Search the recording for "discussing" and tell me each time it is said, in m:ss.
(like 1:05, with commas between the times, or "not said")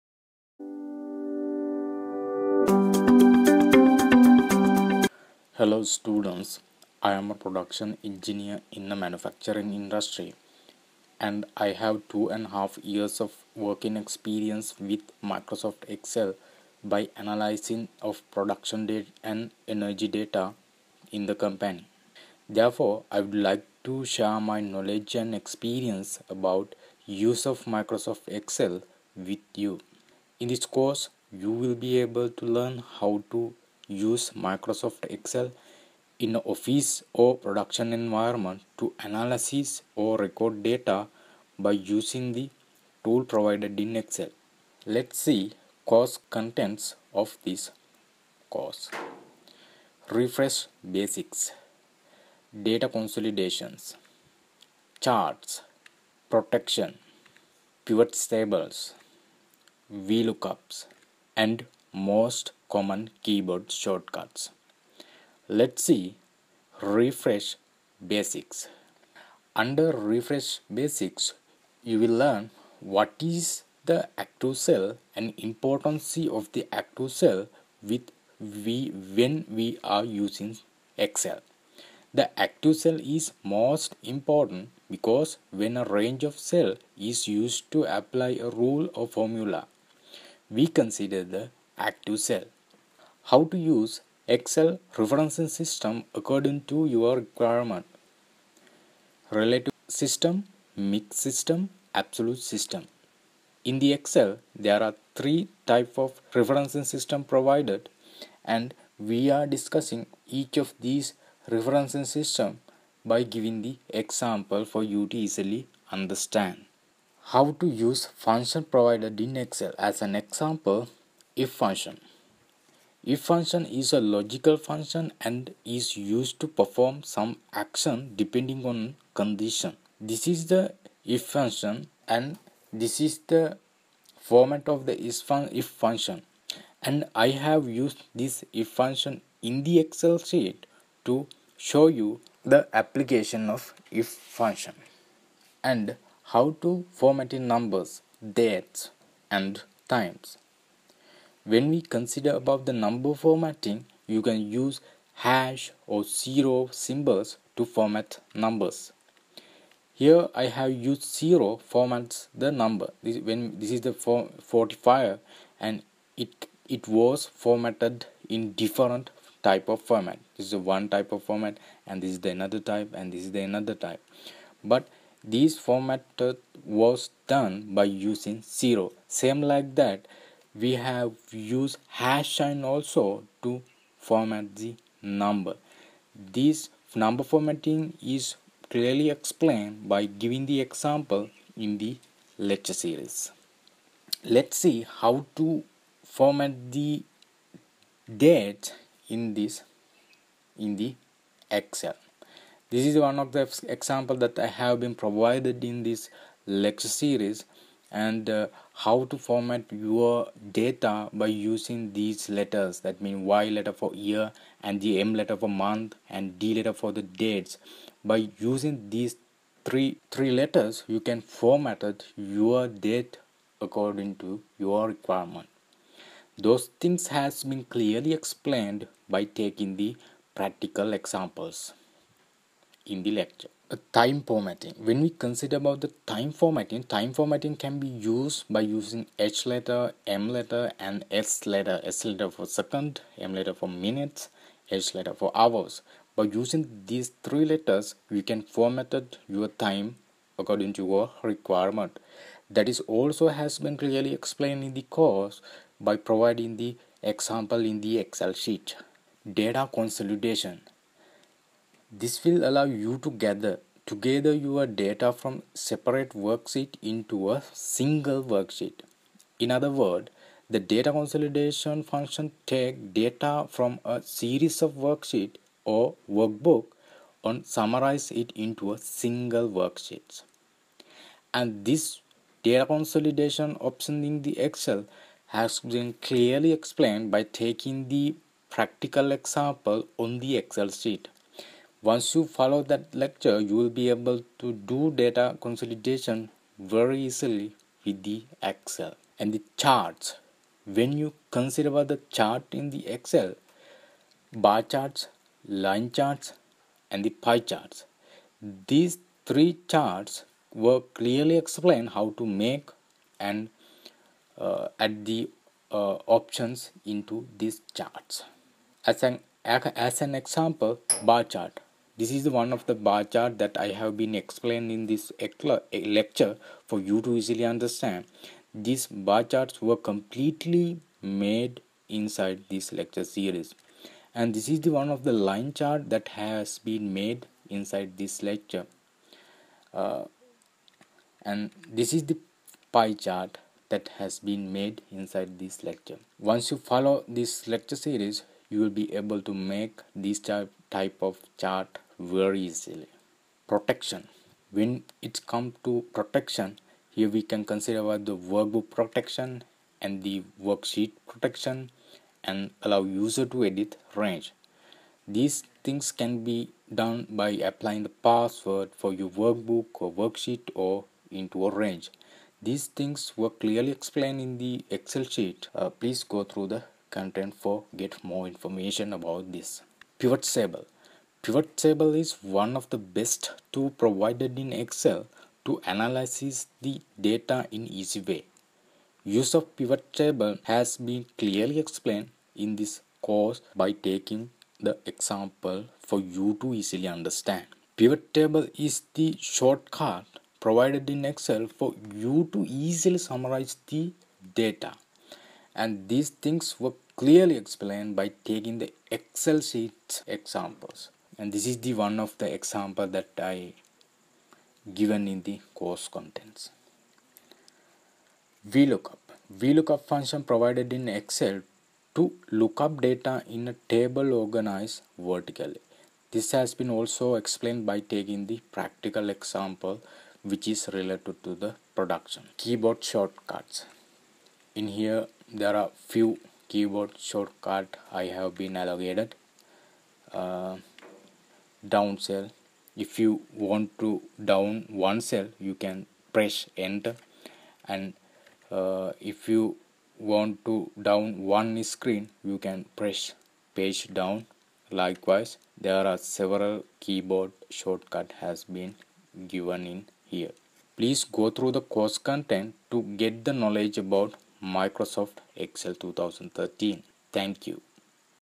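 1:49.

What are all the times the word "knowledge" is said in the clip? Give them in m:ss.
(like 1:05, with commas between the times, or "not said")
0:24, 7:43.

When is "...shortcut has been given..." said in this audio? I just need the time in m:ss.
7:37.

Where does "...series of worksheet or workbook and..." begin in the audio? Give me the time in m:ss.
4:34.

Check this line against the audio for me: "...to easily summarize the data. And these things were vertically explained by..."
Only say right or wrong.
wrong.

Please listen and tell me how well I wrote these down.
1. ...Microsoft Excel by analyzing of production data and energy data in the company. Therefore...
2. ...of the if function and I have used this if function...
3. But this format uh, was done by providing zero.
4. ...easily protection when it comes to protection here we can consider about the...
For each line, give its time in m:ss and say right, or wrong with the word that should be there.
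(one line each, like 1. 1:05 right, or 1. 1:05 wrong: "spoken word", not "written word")
1. 0:15 right
2. 2:14 right
3. 2:54 wrong: "using", not "providing"
4. 5:52 right.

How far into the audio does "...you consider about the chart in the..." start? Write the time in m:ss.
5:00.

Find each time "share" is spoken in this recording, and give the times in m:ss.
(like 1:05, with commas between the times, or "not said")
0:24.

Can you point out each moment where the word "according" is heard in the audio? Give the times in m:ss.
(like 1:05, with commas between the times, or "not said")
1:36, 3:43, 4:10.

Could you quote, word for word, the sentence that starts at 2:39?
Here I have used zero formats the number.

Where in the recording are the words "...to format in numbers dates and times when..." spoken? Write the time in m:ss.
2:26.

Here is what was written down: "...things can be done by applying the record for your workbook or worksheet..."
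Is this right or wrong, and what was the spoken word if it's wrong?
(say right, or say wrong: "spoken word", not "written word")
wrong: "password", not "record".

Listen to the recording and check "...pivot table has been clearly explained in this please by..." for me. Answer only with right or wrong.
wrong.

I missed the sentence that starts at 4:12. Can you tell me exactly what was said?
That is also has been clearly explained in the course by providing the example in the Excel sheet.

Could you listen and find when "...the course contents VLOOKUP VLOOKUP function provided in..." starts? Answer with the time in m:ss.
6:55.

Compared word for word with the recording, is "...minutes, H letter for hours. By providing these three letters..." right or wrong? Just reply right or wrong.
wrong.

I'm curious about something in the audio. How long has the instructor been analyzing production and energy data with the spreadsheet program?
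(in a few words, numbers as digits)
2.5 years.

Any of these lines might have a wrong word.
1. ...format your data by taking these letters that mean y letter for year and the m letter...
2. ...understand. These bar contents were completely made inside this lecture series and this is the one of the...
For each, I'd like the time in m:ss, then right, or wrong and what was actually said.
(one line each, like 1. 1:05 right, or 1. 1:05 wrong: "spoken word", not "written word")
1. 3:29 wrong: "using", not "taking"
2. 5:27 wrong: "charts", not "contents".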